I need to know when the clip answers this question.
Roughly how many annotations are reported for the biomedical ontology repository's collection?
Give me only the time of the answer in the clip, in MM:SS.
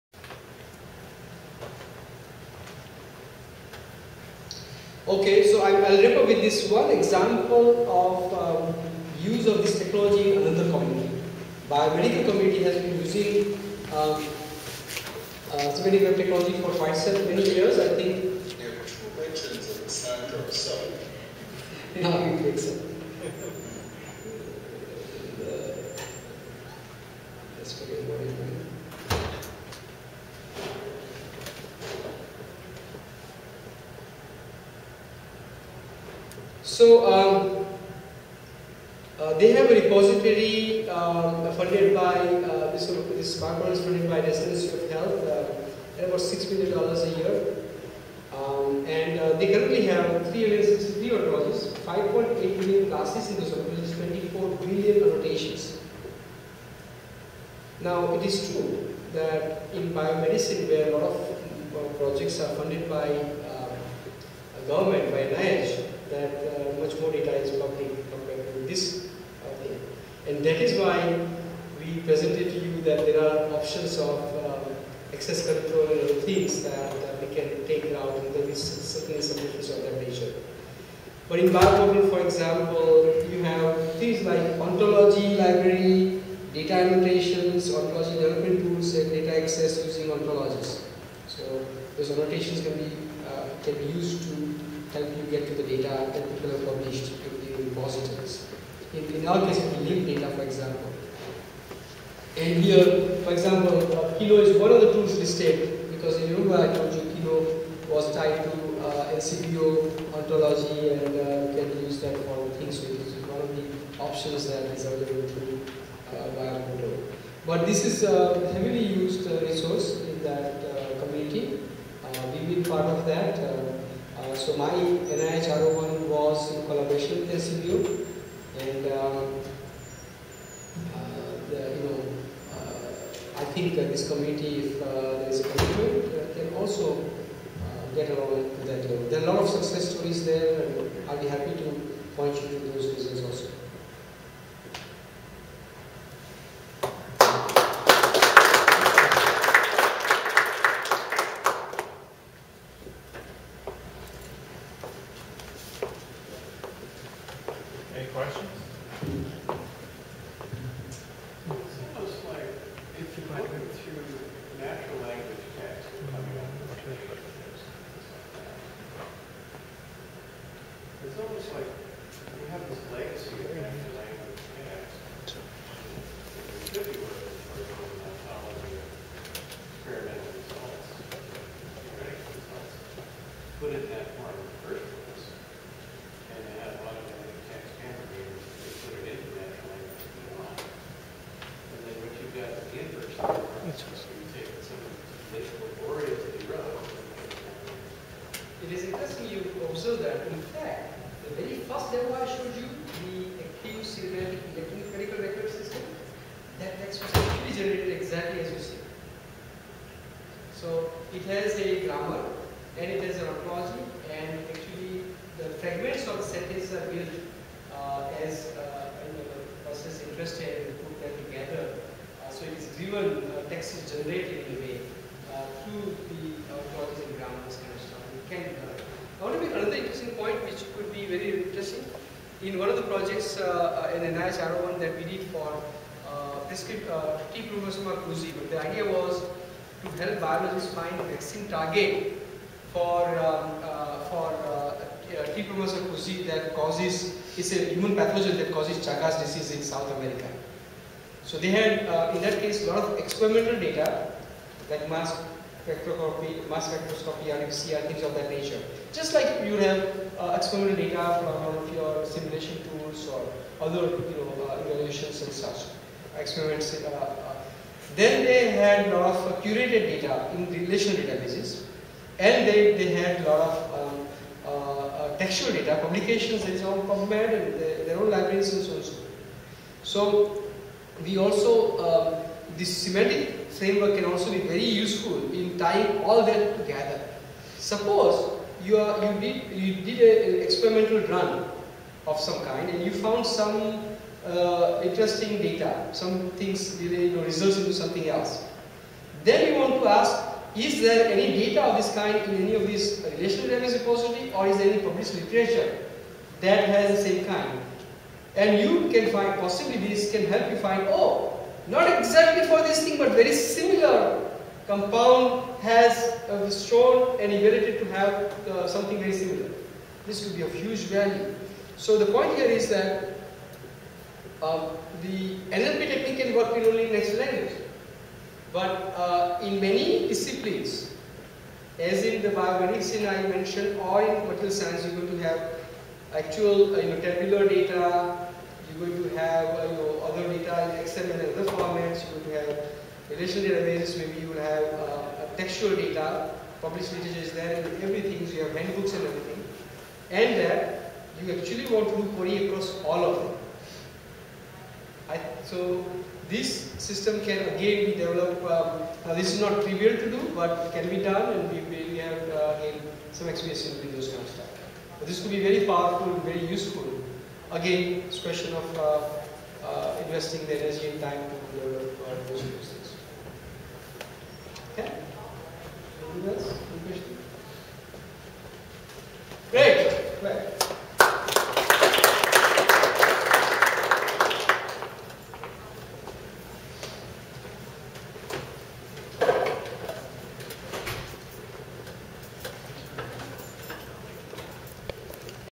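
00:54.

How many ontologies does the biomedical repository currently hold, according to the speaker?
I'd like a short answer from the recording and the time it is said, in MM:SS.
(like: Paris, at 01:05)
363, at 00:50.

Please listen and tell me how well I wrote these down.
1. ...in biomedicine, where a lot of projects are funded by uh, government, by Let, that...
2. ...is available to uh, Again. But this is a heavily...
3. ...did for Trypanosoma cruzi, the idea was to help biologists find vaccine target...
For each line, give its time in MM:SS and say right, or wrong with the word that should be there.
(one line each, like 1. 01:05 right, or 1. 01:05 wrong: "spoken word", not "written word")
1. 00:59 wrong: "NIH", not "Let"
2. 01:54 wrong: "BioPortal", not "Again"
3. 03:55 right.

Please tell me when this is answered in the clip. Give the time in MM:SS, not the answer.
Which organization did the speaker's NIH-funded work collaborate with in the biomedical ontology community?
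02:07.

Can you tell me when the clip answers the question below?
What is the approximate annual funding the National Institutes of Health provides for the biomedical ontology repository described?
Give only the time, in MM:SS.
00:46.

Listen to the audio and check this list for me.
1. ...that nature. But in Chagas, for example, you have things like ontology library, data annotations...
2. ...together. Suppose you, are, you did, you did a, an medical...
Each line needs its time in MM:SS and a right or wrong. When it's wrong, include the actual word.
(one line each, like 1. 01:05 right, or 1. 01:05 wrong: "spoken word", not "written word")
1. 01:19 wrong: "BioPortal", not "Chagas"
2. 04:46 wrong: "experimental", not "medical".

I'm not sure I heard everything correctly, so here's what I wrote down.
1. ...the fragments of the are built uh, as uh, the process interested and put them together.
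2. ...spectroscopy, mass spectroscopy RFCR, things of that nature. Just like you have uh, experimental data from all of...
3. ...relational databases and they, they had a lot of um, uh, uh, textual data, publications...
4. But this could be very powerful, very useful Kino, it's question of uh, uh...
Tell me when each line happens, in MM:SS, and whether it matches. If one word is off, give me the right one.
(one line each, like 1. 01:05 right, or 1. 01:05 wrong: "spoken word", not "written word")
1. 03:35 right
2. 04:15 right
3. 04:30 right
4. 06:04 wrong: "Again", not "Kino".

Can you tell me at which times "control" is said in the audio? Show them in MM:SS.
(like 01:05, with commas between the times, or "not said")
01:15.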